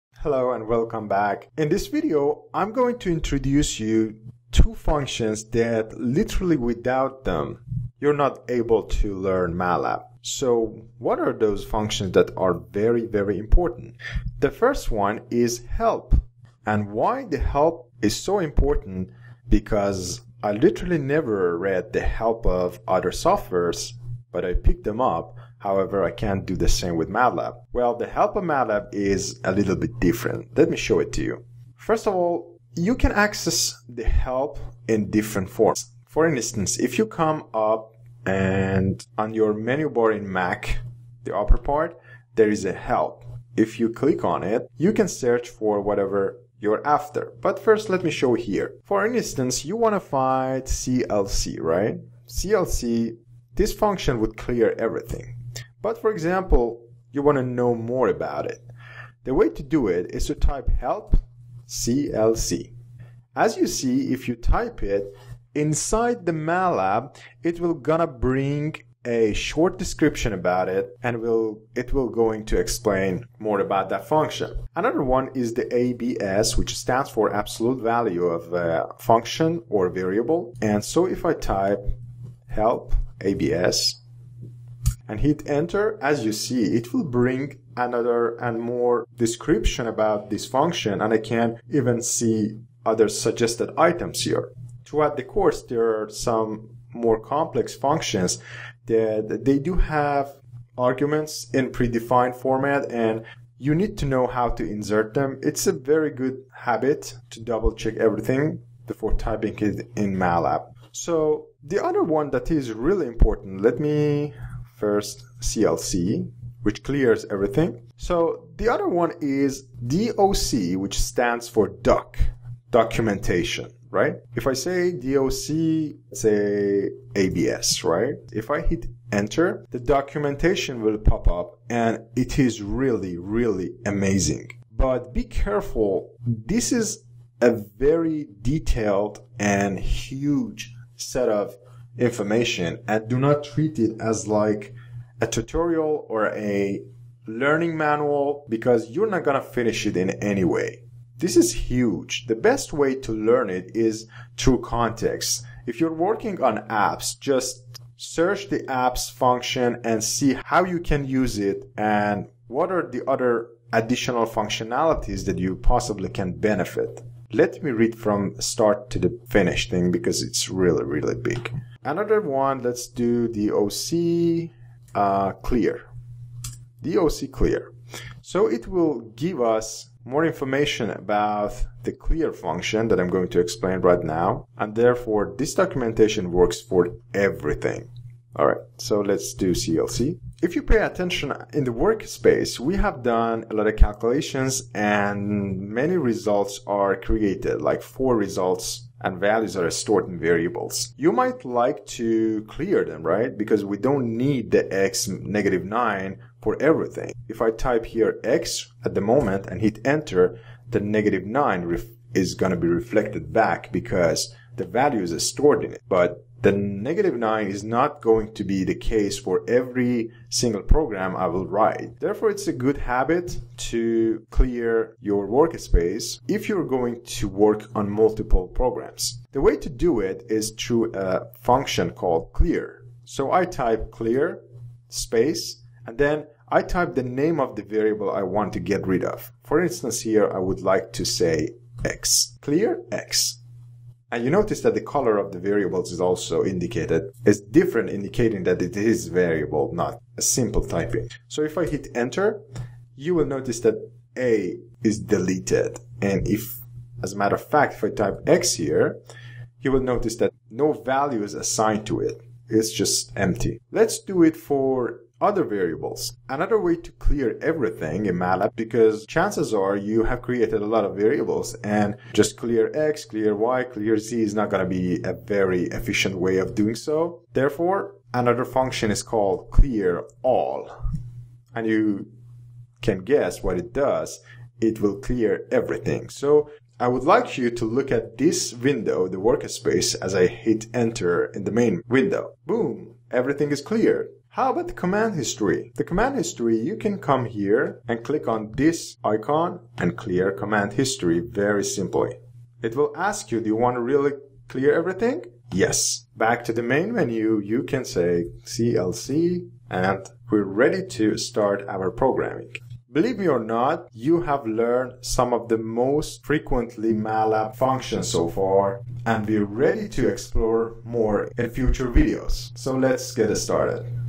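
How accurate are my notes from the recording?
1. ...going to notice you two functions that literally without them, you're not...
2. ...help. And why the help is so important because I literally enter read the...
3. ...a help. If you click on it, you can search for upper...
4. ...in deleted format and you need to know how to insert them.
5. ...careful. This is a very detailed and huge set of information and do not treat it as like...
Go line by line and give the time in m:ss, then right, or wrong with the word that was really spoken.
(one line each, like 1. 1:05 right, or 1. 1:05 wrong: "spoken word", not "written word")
1. 0:02 wrong: "introduce", not "notice"
2. 0:15 wrong: "never", not "enter"
3. 0:42 wrong: "whatever", not "upper"
4. 1:41 wrong: "predefined", not "deleted"
5. 2:15 right.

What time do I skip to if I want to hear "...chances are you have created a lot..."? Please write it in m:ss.
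4:29.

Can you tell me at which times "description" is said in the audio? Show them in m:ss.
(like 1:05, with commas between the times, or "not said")
1:09, 1:29.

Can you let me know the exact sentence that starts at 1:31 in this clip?
And I can even see other suggested items here.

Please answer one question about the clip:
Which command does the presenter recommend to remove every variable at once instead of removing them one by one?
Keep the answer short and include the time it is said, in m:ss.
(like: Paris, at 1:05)
clear all, at 4:39.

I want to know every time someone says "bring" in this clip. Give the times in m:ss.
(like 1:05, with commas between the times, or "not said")
1:08, 1:27.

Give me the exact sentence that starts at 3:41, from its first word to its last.
Therefore, it's a good habit to clear your workspace if you're going to work on multiple programs.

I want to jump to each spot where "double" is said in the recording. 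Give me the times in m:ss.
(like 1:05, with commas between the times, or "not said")
1:47.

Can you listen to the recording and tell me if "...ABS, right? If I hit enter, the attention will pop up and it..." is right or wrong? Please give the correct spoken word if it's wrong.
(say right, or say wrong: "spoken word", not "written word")
wrong: "documentation", not "attention".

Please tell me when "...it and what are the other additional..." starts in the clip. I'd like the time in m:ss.
2:41.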